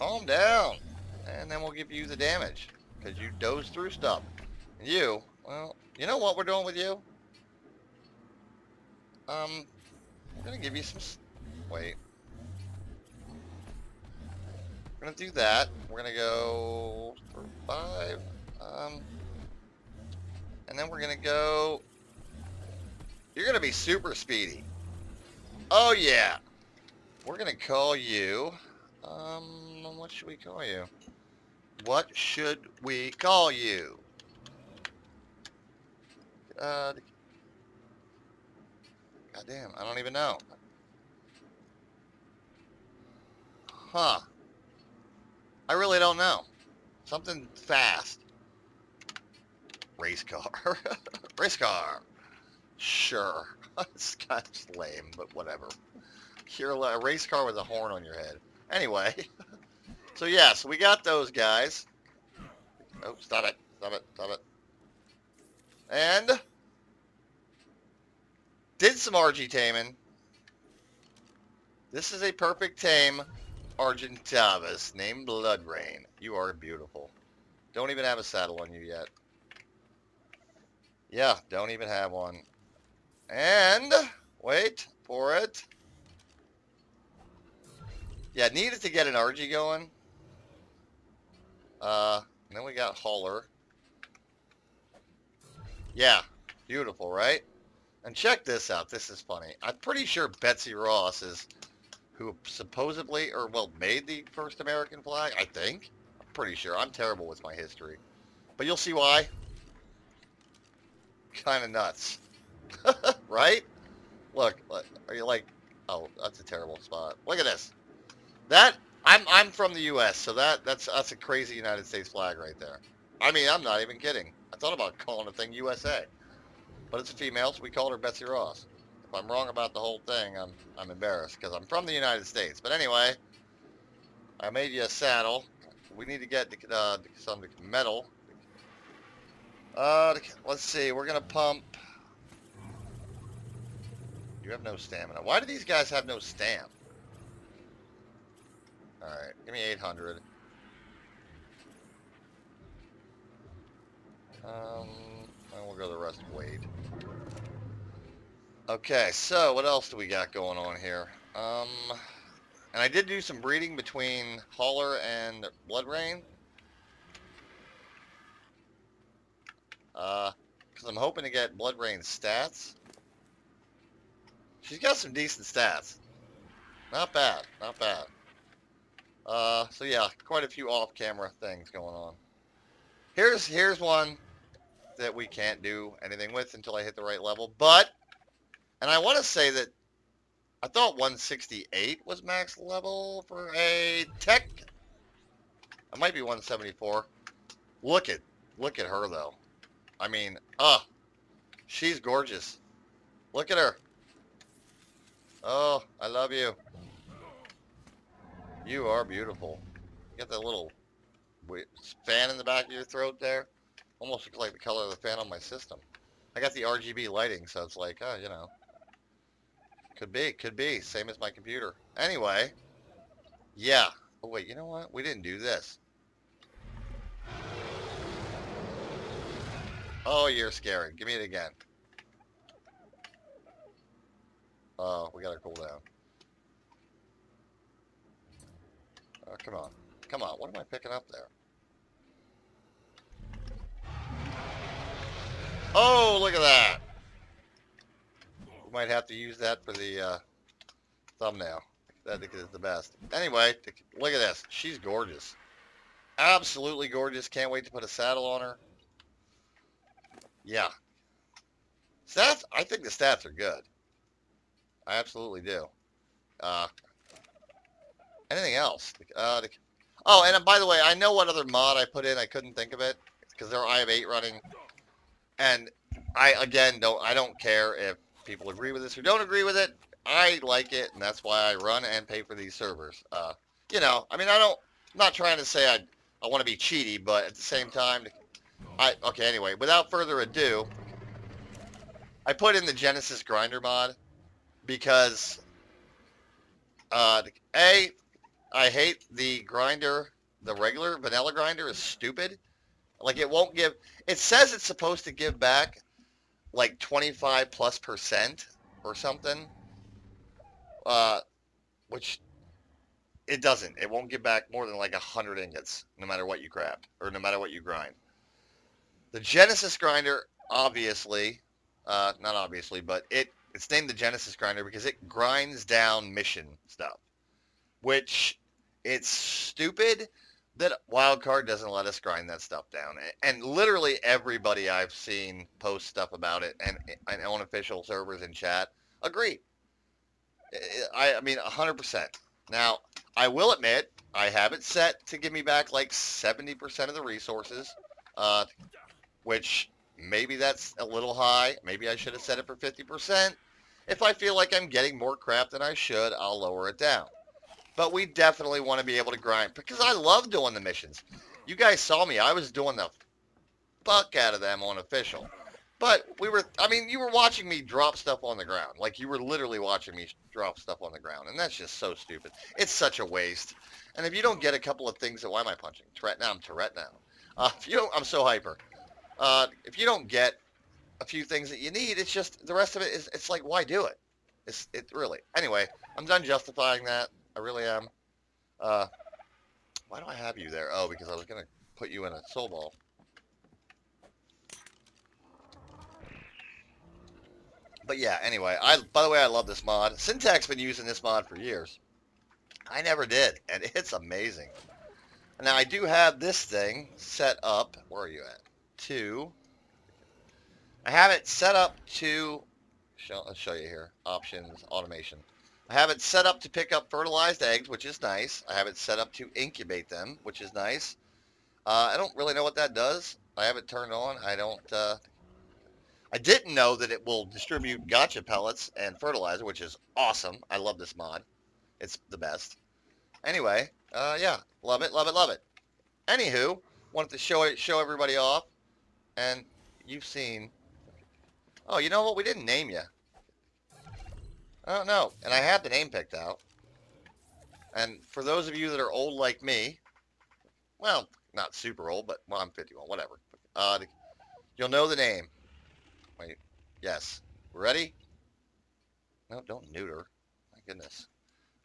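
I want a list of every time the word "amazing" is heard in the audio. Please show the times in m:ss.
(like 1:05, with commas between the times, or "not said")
6:43.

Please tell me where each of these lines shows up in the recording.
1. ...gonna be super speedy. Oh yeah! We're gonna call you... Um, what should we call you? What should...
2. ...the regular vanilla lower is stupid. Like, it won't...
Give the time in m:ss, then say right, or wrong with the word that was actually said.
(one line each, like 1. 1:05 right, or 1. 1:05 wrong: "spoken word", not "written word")
1. 0:23 right
2. 5:00 wrong: "grinder", not "lower".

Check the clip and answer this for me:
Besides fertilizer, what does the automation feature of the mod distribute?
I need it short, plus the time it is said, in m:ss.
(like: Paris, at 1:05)
Gacha pellets, at 7:07.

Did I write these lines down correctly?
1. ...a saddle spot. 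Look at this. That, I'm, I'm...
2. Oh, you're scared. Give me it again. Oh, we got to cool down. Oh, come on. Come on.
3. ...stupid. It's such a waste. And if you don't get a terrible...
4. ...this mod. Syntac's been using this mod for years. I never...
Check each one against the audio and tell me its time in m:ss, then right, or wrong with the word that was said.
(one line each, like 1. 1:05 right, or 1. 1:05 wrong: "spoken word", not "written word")
1. 1:56 wrong: "terrible", not "saddle"
2. 3:50 right
3. 6:11 wrong: "couple", not "terrible"
4. 6:39 right.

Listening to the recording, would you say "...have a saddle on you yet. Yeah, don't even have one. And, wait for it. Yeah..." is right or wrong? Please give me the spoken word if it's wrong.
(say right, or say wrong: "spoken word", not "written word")
right.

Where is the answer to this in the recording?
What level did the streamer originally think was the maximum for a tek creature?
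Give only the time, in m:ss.
3:10.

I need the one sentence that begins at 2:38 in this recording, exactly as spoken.
Okay, so what else do we got going on here?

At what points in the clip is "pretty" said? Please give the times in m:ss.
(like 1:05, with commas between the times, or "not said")
1:39, 1:46.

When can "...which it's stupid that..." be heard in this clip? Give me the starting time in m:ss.
5:27.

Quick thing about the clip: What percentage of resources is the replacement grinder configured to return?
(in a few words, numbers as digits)
70%.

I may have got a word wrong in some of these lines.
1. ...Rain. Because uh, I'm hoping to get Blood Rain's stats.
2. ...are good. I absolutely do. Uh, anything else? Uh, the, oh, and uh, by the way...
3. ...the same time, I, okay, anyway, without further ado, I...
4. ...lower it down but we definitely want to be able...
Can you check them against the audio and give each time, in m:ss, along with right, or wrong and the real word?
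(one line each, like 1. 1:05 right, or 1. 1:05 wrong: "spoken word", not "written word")
1. 2:45 right
2. 4:23 right
3. 4:47 right
4. 5:56 right.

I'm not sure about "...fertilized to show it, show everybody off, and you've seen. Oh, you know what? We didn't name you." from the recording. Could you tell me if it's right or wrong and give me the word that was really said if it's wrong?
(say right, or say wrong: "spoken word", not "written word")
wrong: "wanted", not "fertilized".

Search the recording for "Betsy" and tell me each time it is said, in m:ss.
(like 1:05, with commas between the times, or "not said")
1:40, 2:07.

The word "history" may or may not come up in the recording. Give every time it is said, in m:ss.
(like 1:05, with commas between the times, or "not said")
1:47.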